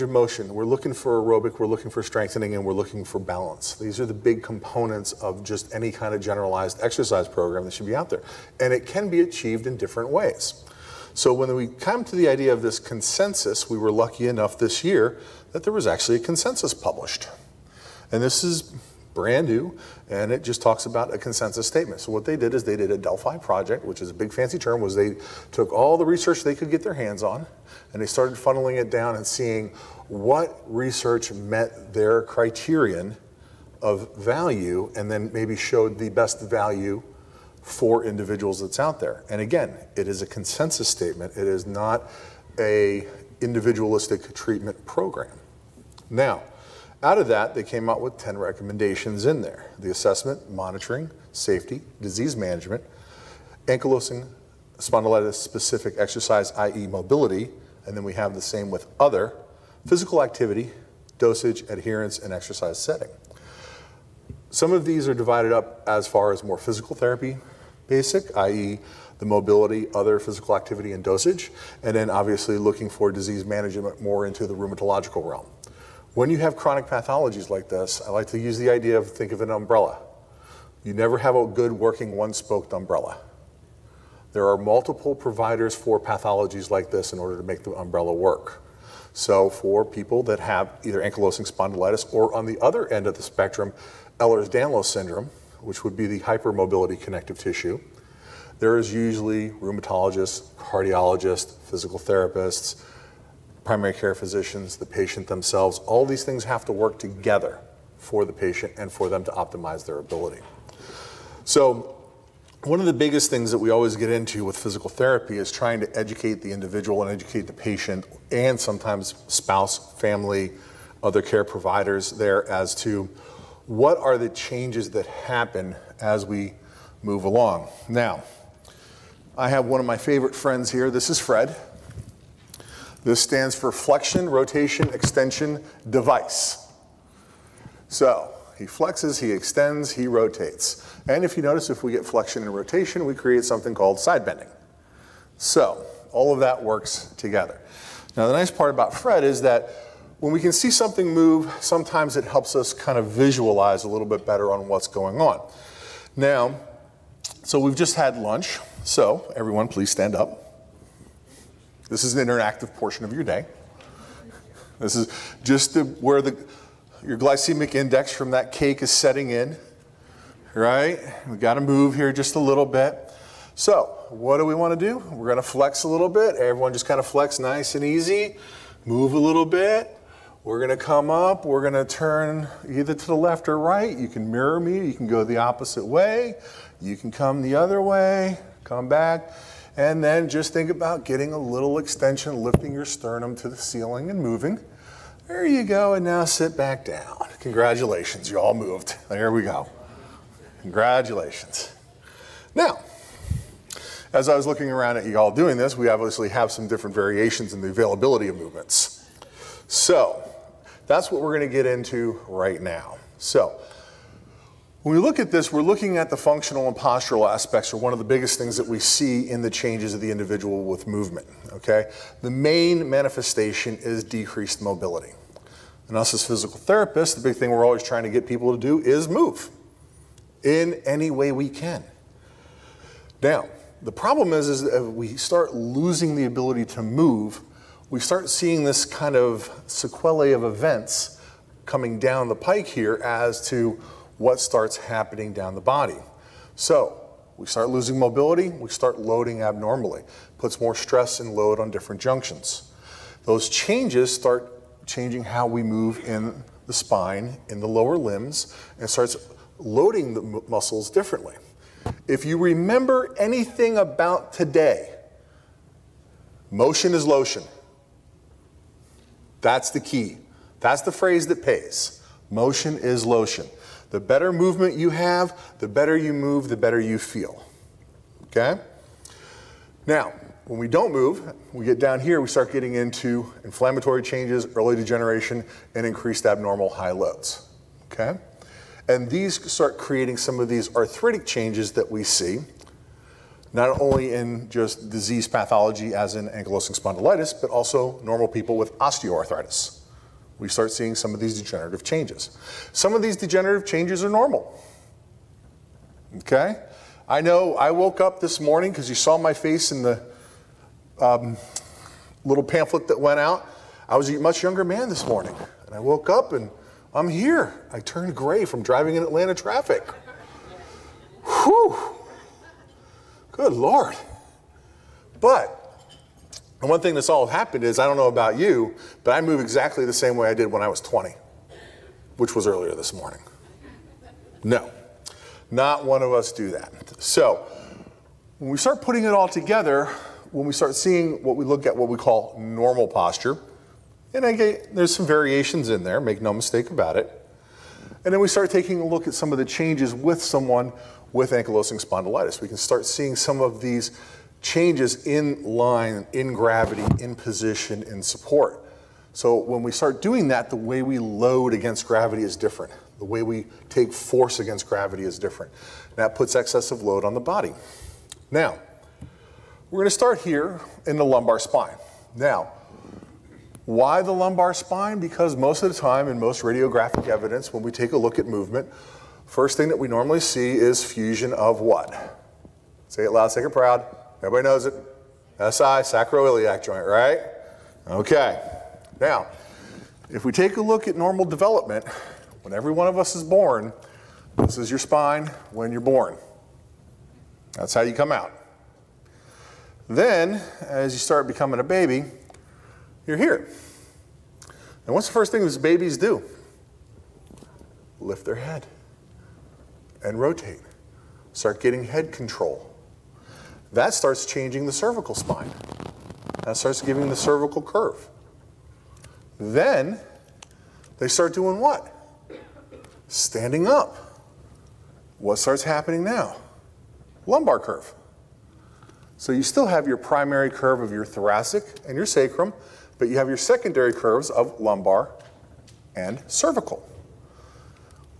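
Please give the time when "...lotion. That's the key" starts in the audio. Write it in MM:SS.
04:27.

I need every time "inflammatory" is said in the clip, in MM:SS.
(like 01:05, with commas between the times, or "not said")
04:43.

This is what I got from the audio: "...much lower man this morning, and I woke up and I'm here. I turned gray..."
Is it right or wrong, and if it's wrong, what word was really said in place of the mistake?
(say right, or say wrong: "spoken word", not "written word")
wrong: "younger", not "lower".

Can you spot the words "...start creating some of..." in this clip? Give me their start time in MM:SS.
04:49.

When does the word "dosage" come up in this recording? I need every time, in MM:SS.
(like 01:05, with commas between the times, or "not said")
01:01, 01:11.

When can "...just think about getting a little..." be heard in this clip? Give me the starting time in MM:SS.
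03:10.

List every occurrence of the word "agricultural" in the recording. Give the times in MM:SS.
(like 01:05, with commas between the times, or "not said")
not said.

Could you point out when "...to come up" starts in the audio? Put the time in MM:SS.
03:00.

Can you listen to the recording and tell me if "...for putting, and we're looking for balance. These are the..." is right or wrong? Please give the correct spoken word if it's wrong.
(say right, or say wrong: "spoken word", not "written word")
wrong: "strengthening", not "putting".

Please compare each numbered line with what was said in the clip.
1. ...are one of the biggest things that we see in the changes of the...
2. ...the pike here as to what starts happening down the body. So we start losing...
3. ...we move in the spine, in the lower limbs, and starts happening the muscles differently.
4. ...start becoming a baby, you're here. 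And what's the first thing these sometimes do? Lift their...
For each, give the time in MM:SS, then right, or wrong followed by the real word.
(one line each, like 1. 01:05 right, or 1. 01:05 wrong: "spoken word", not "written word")
1. 03:37 right
2. 04:02 right
3. 04:15 wrong: "loading", not "happening"
4. 06:40 wrong: "babies", not "sometimes".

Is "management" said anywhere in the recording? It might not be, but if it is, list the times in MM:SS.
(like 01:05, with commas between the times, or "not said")
00:52, 01:13.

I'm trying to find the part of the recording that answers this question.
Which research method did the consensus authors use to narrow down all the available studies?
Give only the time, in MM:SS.
00:22.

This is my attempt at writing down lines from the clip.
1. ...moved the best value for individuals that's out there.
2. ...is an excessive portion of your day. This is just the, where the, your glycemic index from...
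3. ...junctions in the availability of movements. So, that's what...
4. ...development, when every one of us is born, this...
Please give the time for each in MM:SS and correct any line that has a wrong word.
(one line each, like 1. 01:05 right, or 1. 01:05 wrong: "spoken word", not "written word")
1. 00:35 wrong: "showed", not "moved"
2. 02:42 wrong: "interactive", not "excessive"
3. 03:26 wrong: "variations", not "junctions"
4. 06:31 right.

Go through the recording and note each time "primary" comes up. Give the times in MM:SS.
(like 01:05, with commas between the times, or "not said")
01:43, 07:09.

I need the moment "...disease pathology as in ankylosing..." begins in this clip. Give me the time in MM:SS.
04:54.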